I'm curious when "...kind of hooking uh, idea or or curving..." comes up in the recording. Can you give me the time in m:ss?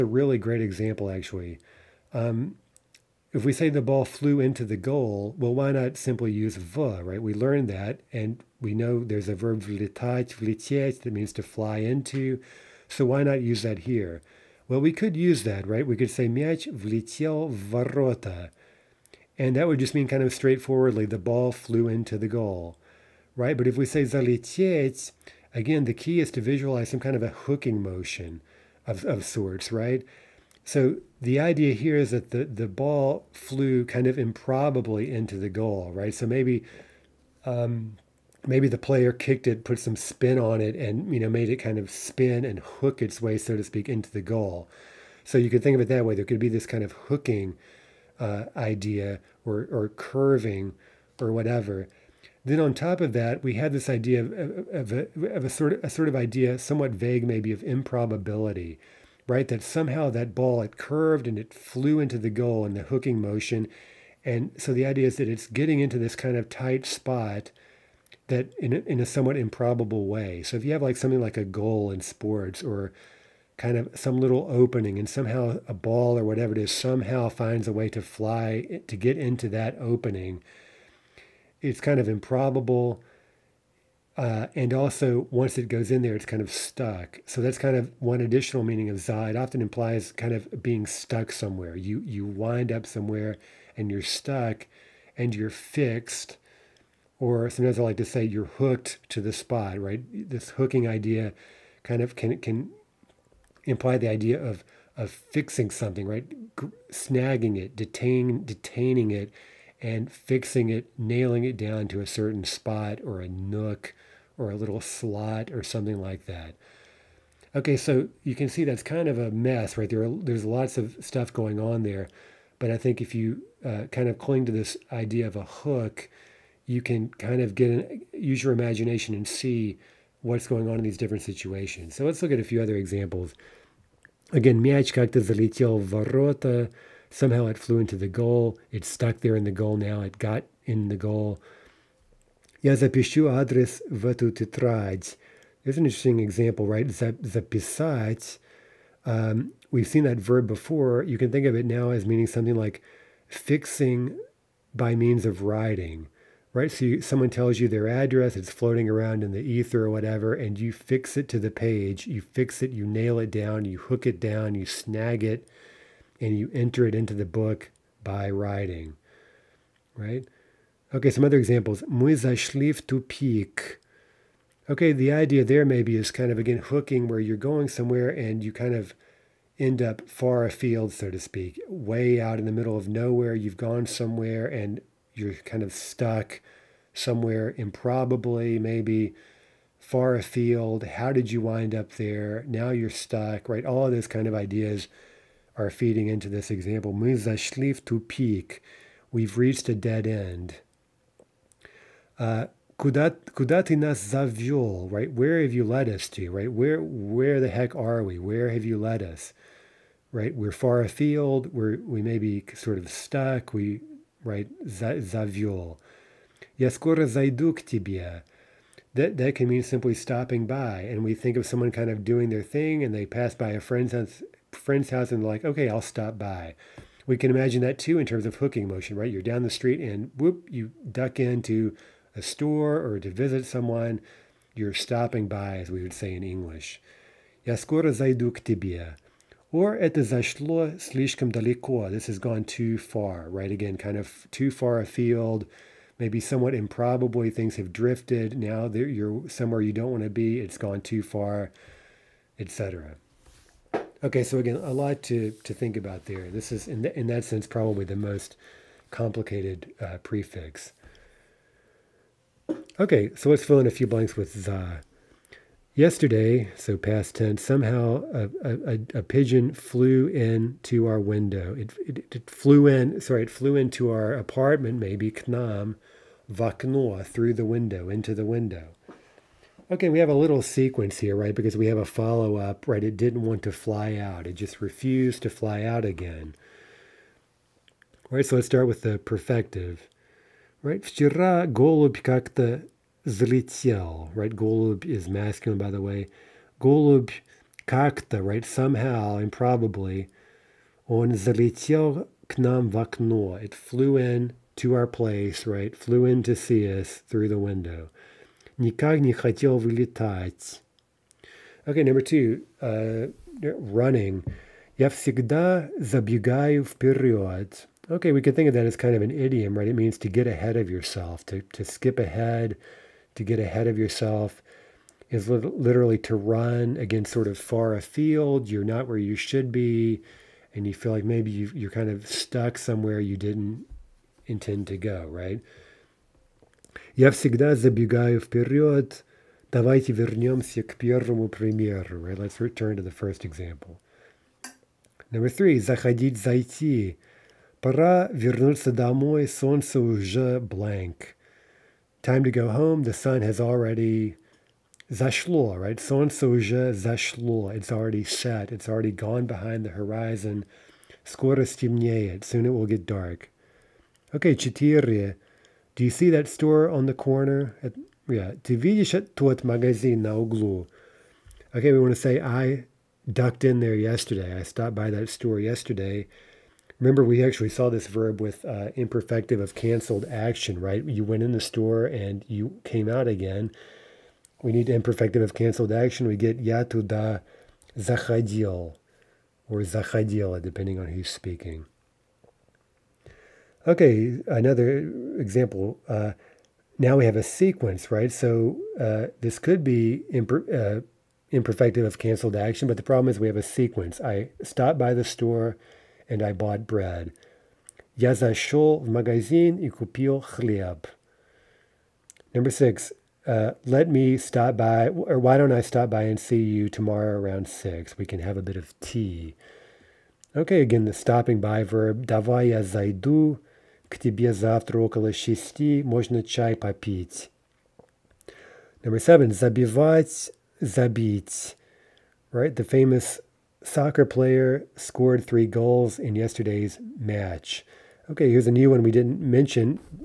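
0:46.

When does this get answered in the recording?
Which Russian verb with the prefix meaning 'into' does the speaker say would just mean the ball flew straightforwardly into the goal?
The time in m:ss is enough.
0:09.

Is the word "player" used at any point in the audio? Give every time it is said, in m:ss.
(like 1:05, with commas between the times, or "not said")
0:38, 7:14.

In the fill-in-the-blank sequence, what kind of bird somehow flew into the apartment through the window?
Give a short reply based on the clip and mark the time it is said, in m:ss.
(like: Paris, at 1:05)
a pigeon, at 4:29.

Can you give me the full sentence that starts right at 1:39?
Right, this hooking idea, kind of can can imply the idea of of fixing something.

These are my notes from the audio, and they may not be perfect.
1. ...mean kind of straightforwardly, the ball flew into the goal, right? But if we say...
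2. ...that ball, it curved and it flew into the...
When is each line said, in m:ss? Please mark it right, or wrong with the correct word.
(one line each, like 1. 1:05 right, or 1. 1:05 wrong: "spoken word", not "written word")
1. 0:19 right
2. 1:00 right.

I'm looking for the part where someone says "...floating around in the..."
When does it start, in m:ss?
2:38.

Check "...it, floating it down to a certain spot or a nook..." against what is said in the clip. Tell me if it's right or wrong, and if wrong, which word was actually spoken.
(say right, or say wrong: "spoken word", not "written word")
wrong: "nailing", not "floating".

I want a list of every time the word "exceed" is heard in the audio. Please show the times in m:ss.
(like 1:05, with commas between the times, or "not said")
not said.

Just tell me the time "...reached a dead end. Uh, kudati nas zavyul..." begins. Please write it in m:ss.
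3:19.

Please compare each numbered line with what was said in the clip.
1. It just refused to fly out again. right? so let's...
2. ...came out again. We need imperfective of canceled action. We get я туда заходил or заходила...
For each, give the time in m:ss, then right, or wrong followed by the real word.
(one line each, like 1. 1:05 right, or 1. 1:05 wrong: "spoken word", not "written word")
1. 4:44 right
2. 6:22 right.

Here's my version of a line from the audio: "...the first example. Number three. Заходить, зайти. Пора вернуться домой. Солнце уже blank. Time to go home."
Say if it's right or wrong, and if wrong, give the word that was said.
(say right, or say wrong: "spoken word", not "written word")
right.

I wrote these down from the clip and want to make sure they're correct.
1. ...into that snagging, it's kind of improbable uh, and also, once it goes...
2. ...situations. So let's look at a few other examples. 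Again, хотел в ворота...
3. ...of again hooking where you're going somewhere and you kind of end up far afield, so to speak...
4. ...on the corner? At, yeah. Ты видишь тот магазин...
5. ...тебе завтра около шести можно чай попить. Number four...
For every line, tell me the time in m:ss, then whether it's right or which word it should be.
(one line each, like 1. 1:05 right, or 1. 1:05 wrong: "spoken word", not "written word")
1. 1:19 wrong: "opening", not "snagging"
2. 2:11 wrong: "залетел", not "хотел"
3. 2:56 right
4. 6:06 right
5. 7:03 wrong: "seven", not "four".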